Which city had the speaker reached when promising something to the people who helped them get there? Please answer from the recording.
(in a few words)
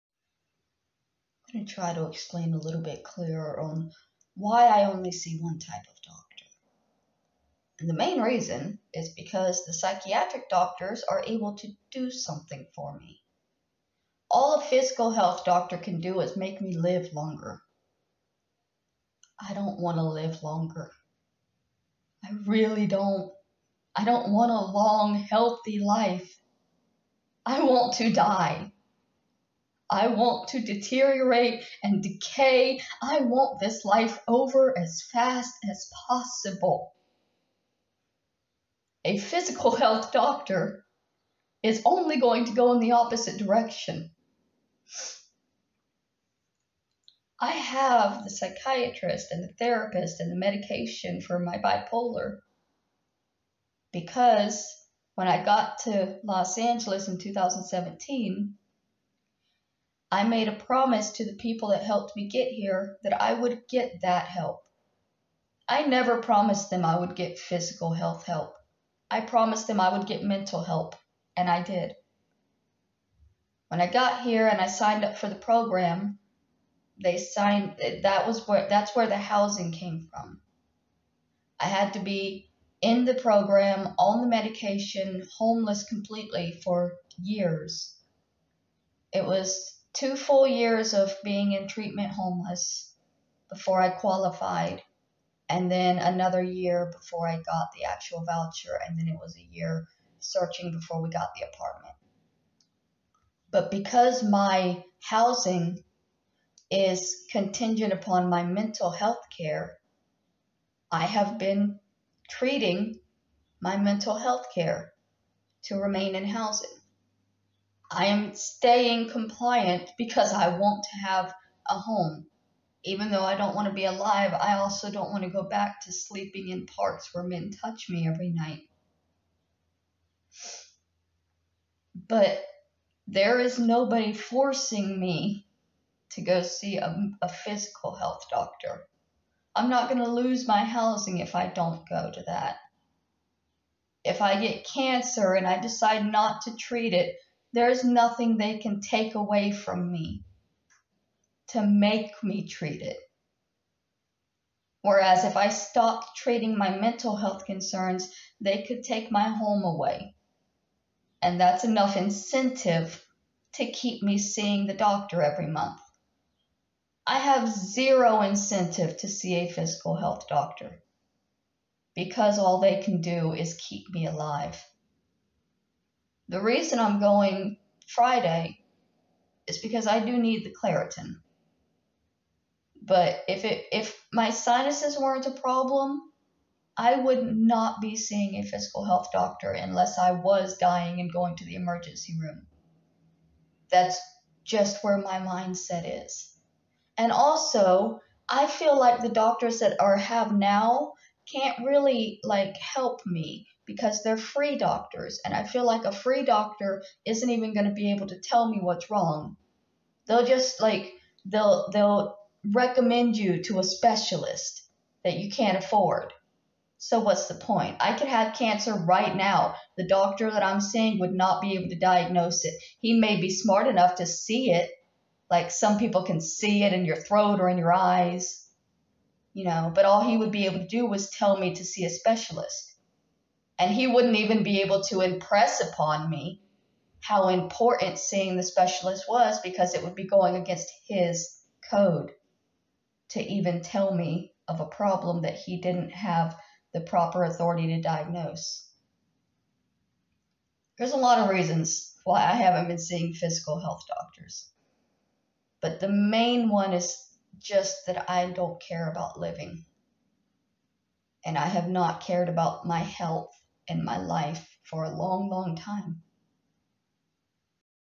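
Los Angeles.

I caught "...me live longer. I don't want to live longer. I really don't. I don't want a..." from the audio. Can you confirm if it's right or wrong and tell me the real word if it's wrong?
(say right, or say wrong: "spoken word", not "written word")
right.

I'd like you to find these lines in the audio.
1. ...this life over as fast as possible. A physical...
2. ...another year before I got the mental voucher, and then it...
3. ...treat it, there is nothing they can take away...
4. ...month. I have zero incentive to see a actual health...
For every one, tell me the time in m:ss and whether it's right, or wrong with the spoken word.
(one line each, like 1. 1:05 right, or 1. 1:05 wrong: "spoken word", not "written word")
1. 0:33 right
2. 1:35 wrong: "actual", not "mental"
3. 2:26 right
4. 2:45 wrong: "physical", not "actual".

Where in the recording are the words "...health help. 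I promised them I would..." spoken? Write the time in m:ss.
1:07.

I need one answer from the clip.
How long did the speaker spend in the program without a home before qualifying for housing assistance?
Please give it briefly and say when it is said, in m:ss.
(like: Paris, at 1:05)
2 full years, at 1:29.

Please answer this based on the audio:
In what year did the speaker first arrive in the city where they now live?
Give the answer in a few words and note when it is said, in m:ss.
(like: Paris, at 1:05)
2017, at 0:57.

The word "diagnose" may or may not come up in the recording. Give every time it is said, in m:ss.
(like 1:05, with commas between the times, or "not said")
3:41, 4:07.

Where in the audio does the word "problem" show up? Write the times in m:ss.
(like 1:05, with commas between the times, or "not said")
3:05, 4:04.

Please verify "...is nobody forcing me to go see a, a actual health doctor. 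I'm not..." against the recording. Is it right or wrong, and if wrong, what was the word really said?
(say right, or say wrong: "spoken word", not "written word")
wrong: "physical", not "actual".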